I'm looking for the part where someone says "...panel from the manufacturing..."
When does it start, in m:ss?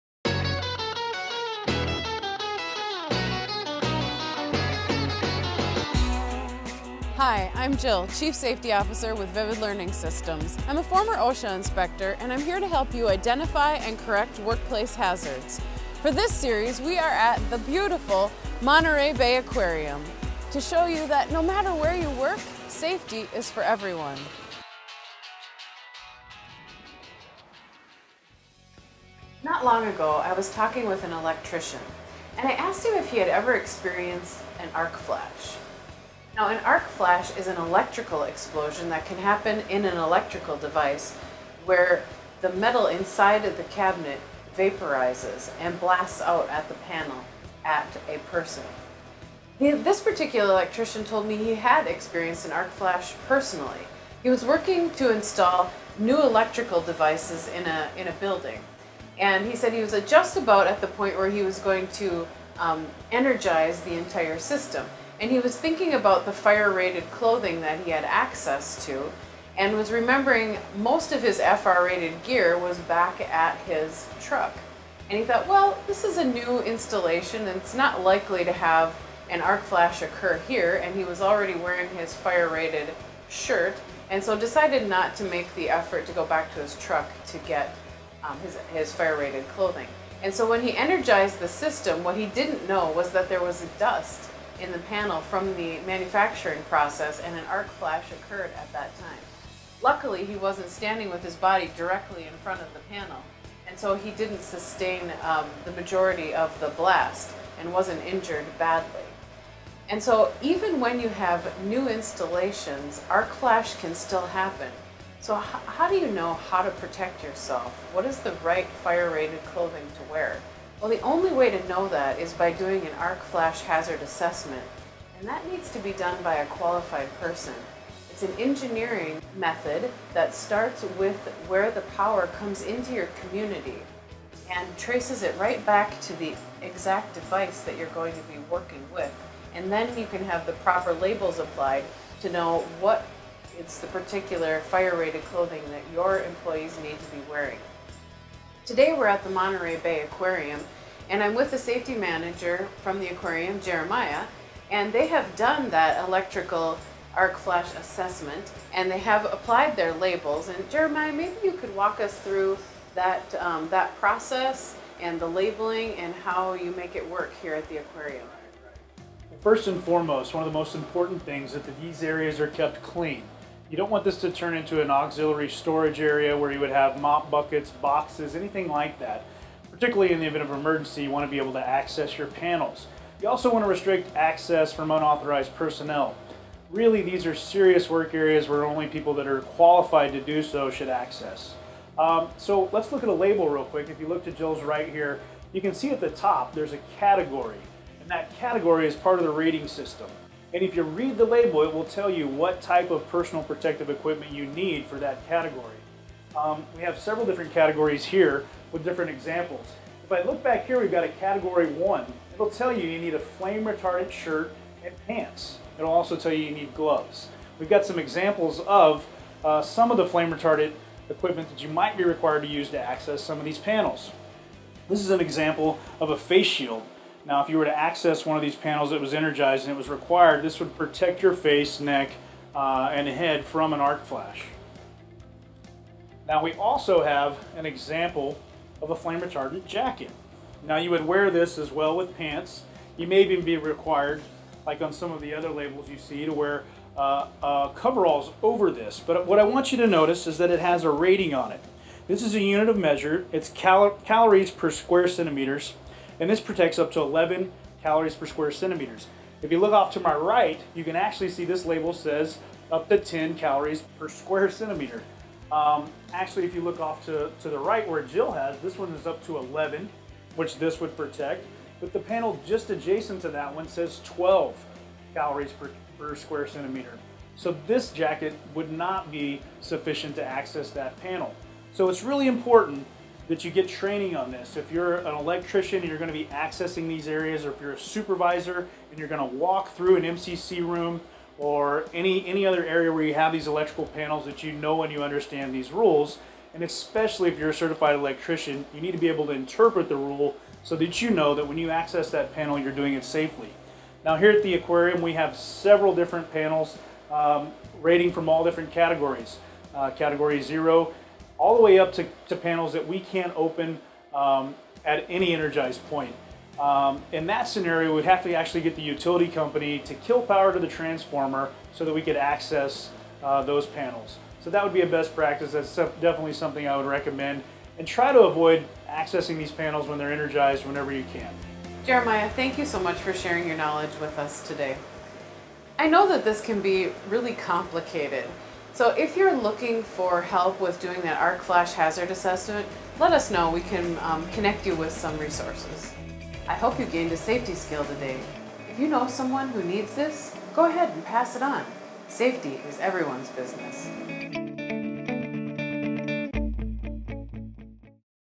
1:34.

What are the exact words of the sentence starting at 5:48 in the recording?
If you know someone who needs this, go ahead and pass it on.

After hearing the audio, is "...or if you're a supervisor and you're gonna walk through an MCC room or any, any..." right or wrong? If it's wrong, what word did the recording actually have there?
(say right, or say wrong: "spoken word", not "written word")
right.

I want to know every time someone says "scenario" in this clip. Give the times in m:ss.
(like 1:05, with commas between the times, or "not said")
5:17.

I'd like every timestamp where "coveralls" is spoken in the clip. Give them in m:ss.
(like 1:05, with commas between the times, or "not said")
4:07.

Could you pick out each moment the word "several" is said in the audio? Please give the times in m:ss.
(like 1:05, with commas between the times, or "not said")
3:26, 5:05.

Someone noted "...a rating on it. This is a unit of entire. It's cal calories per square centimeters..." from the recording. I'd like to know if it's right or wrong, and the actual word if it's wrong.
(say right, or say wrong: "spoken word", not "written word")
wrong: "measure", not "entire".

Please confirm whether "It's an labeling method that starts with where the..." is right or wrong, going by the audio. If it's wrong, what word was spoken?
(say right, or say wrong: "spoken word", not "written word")
wrong: "engineering", not "labeling".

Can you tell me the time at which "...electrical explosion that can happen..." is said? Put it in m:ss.
0:37.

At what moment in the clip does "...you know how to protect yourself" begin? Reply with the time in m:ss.
1:55.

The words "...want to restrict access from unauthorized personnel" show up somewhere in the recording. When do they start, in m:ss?
3:03.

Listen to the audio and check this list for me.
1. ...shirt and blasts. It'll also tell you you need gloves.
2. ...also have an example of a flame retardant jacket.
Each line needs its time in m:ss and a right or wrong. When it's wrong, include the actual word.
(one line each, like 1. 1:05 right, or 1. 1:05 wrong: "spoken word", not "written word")
1. 3:34 wrong: "pants", not "blasts"
2. 3:56 right.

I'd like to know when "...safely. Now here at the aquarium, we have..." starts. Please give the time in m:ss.
5:03.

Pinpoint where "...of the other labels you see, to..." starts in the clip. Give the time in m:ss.
4:05.